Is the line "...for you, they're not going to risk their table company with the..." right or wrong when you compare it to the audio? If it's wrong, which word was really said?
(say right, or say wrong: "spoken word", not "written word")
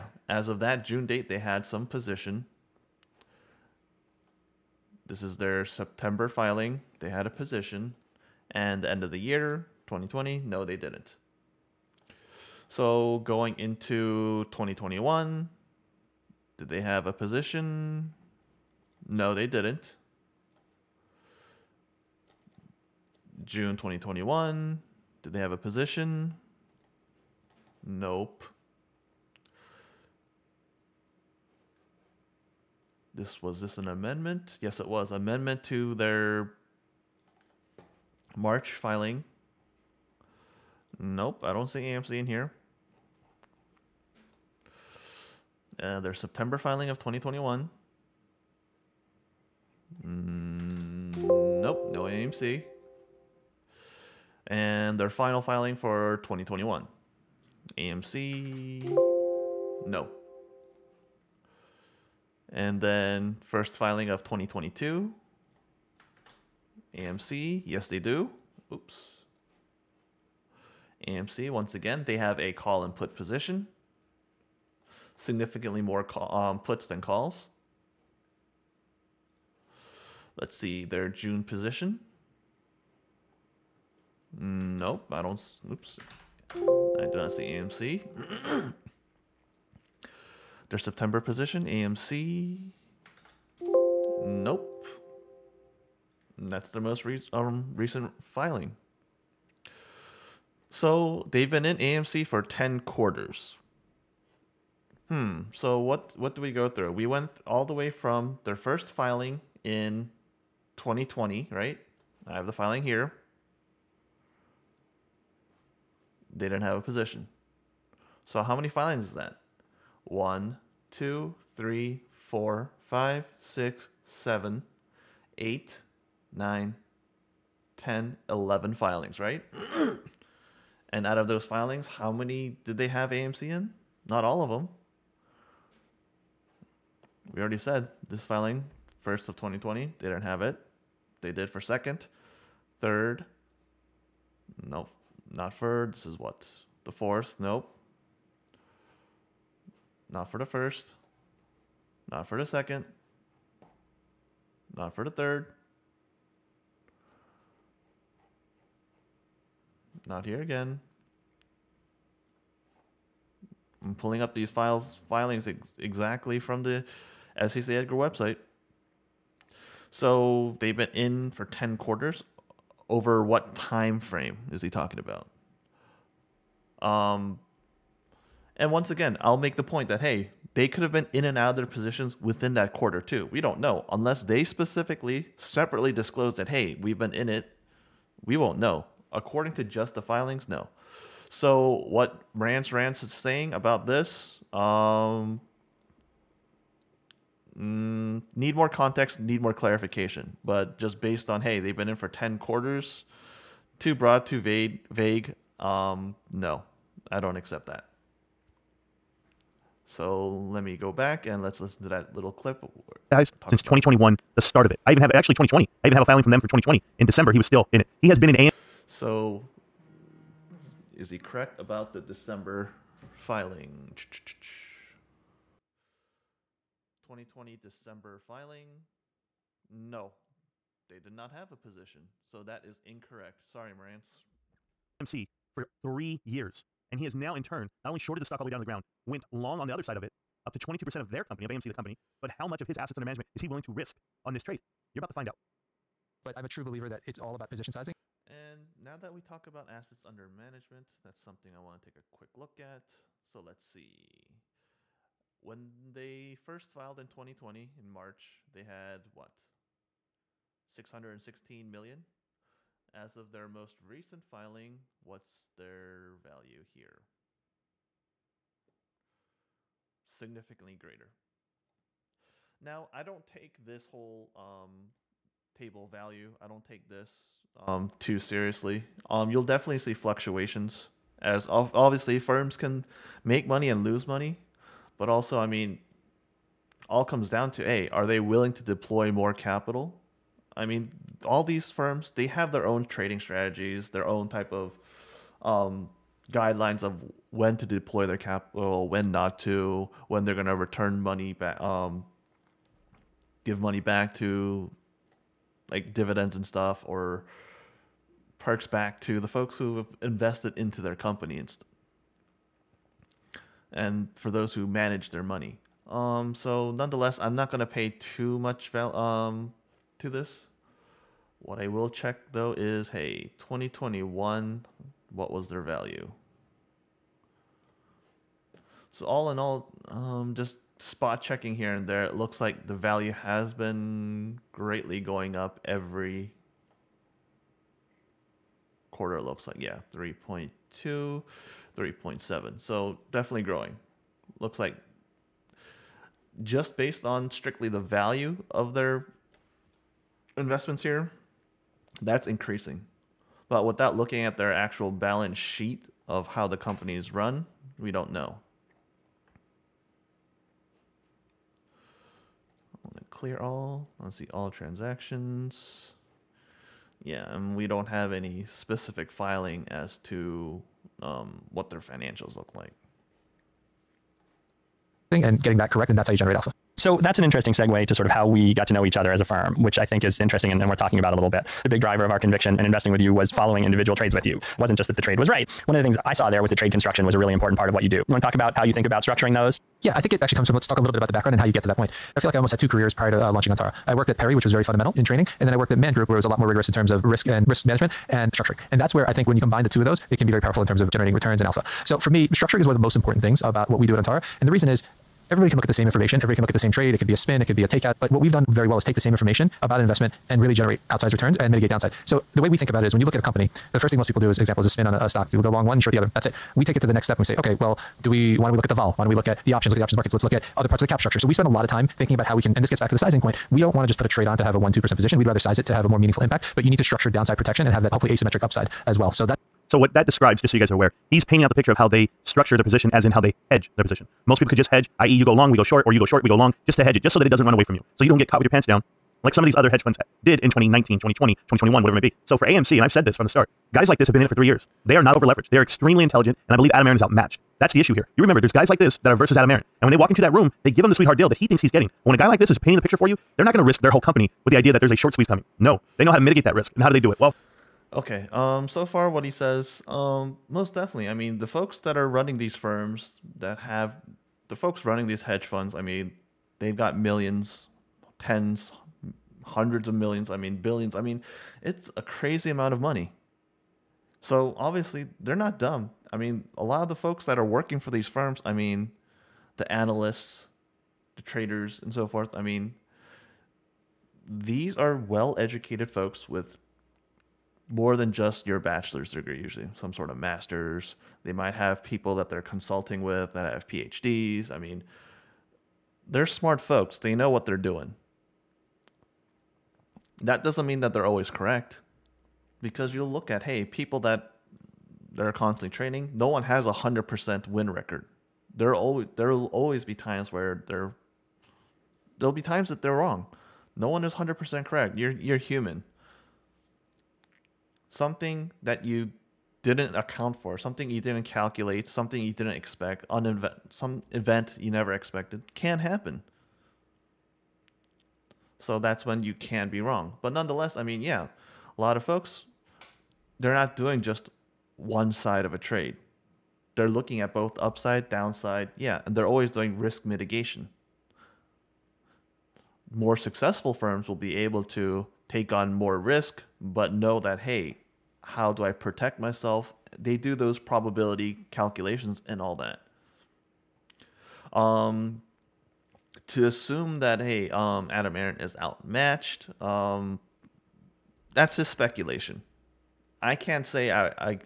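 wrong: "whole", not "table".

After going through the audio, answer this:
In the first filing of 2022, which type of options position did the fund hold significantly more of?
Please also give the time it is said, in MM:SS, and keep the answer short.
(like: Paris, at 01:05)
Puts, at 01:15.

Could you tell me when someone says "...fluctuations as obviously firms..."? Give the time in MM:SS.
04:39.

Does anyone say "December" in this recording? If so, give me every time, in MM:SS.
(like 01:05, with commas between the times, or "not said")
03:37, 03:42, 03:47.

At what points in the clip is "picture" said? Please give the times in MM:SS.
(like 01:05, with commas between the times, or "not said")
07:11, 07:32.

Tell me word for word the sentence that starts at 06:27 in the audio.
You want to talk about how you think about structuring those?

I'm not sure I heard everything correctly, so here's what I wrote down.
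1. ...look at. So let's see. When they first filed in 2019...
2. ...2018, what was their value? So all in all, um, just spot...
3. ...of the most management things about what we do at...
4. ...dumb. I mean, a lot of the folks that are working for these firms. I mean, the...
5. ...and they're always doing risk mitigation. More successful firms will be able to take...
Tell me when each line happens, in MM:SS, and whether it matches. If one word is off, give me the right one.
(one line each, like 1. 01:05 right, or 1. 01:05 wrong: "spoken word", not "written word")
1. 04:12 wrong: "2020", not "2019"
2. 05:23 wrong: "2021", not "2018"
3. 06:42 wrong: "important", not "management"
4. 07:55 right
5. 08:59 right.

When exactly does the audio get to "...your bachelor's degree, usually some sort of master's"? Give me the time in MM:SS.
08:08.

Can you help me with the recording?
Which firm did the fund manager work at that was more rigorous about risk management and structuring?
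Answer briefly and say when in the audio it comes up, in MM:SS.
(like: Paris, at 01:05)
Man Group, at 06:35.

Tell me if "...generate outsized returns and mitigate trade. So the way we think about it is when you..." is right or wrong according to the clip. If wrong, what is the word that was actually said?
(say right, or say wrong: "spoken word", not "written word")
wrong: "downside", not "trade".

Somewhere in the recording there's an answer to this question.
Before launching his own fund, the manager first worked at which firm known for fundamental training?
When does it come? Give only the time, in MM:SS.
06:34.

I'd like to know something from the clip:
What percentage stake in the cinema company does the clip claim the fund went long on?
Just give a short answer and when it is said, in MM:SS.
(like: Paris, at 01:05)
22%, at 04:00.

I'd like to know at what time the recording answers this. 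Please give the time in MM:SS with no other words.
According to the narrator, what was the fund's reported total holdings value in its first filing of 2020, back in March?
04:20.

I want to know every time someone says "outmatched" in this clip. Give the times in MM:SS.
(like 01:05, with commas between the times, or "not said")
07:27, 09:18.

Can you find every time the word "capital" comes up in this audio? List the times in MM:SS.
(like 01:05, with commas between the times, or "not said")
04:49, 04:58.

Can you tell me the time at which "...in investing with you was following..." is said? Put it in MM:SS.
06:22.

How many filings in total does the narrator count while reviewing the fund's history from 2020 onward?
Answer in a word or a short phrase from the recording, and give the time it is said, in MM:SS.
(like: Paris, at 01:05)
11, at 02:08.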